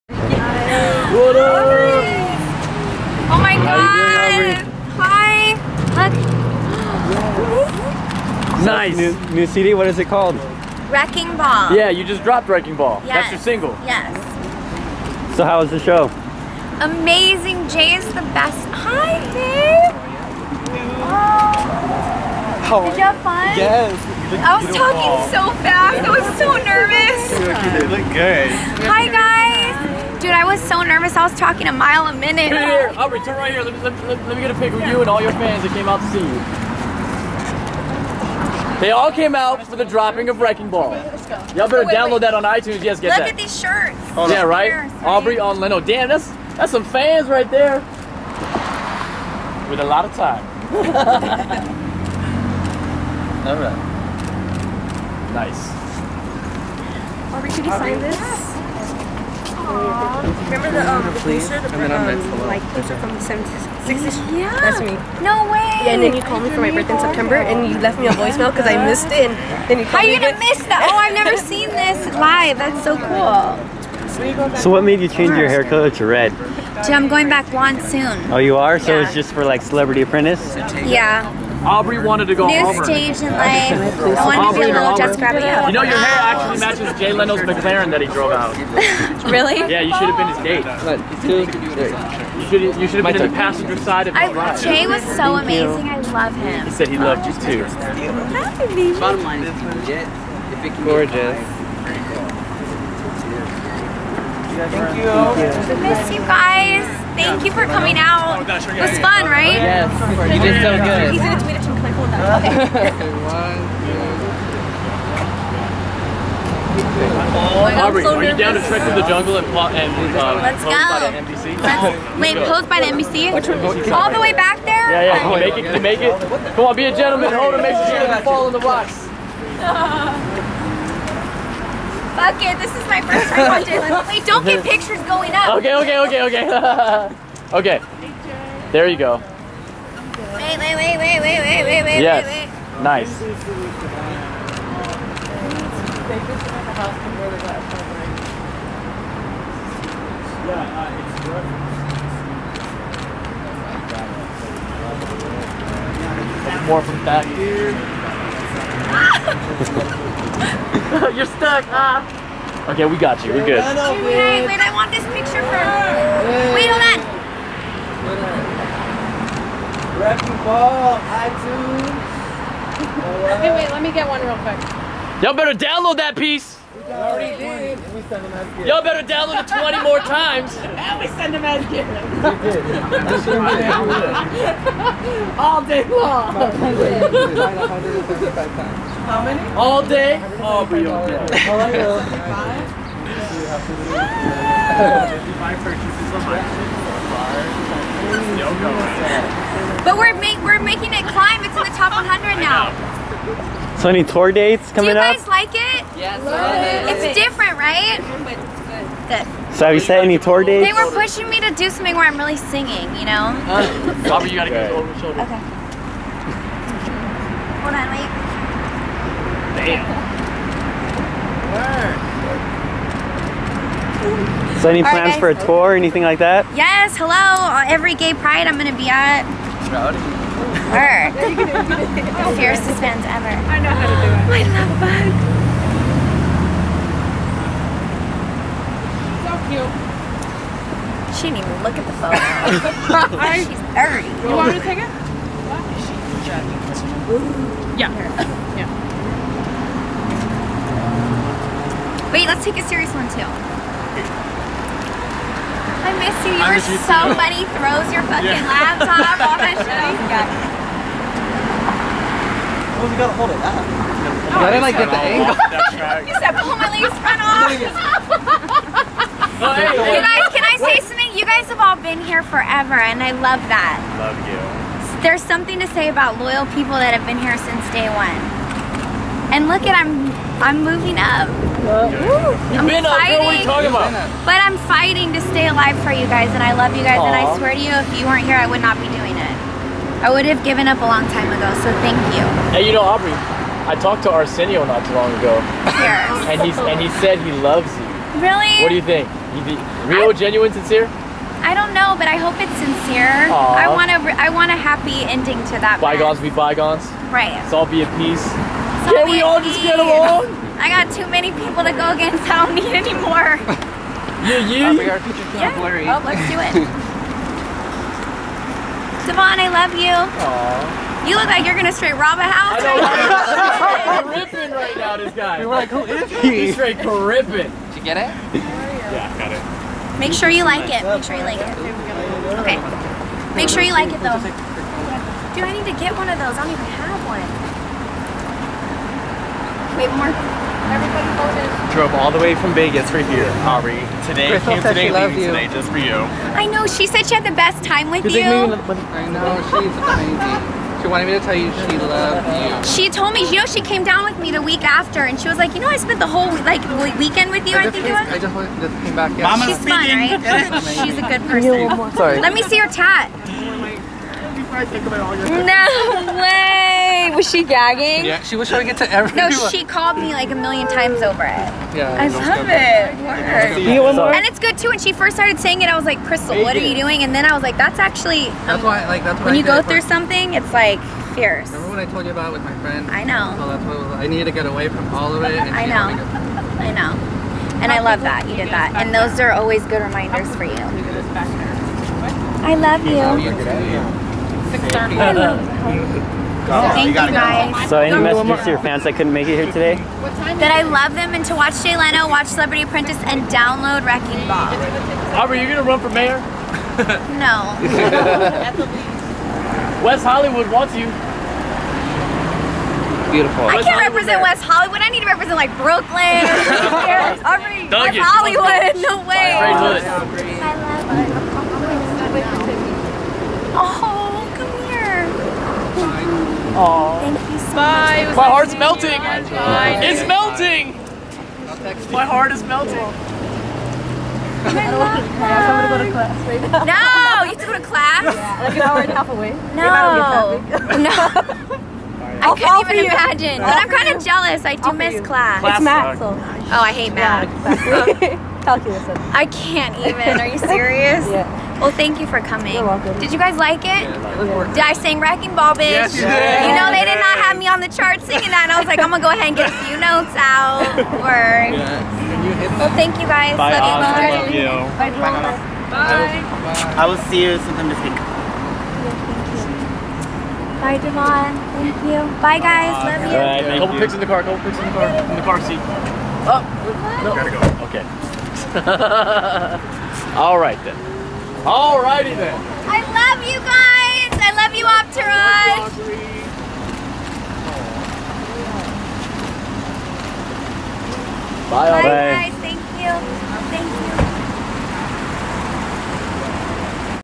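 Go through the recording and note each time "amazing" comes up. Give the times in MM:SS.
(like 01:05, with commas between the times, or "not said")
00:16, 01:35, 05:49.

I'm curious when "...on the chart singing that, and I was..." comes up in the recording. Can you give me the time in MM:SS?
07:37.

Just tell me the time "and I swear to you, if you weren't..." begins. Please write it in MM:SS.
04:47.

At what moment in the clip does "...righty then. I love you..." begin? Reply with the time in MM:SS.
08:01.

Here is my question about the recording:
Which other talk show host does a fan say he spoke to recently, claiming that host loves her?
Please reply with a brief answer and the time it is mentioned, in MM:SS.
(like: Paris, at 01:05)
Arsenio, at 04:54.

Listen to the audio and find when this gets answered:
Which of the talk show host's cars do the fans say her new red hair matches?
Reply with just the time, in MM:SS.
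01:27.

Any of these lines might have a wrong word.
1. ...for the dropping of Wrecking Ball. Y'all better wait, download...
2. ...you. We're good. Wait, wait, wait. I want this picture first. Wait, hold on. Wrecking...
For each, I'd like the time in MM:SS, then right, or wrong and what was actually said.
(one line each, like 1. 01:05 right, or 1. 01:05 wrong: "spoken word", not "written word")
1. 00:39 right
2. 02:43 right.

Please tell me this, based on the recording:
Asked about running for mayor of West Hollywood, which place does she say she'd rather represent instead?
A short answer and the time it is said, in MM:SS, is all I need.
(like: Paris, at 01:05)
Brooklyn, at 06:55.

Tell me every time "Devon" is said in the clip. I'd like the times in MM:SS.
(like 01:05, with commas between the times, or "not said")
05:19, 07:50.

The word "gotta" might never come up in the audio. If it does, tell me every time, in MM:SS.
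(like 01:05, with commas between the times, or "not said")
03:34, 04:22, 07:57.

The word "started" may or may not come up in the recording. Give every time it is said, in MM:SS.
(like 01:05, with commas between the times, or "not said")
06:15.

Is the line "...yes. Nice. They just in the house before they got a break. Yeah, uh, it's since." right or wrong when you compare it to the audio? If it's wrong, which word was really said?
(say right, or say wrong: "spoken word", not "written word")
wrong: "reference", not "since".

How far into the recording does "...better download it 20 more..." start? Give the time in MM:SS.
02:58.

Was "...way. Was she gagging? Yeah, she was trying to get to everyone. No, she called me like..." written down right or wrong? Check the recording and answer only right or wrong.
right.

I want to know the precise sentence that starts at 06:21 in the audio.
Remember when I told you about with my friend?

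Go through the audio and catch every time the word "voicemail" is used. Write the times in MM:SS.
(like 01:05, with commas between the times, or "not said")
01:08.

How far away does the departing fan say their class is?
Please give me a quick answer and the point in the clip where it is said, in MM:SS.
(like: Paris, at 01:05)
An hour and a half, at 07:18.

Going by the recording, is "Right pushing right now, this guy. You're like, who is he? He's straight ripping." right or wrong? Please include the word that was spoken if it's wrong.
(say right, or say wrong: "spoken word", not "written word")
wrong: "ripping", not "pushing".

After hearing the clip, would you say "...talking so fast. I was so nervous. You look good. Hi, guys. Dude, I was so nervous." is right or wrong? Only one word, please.
right.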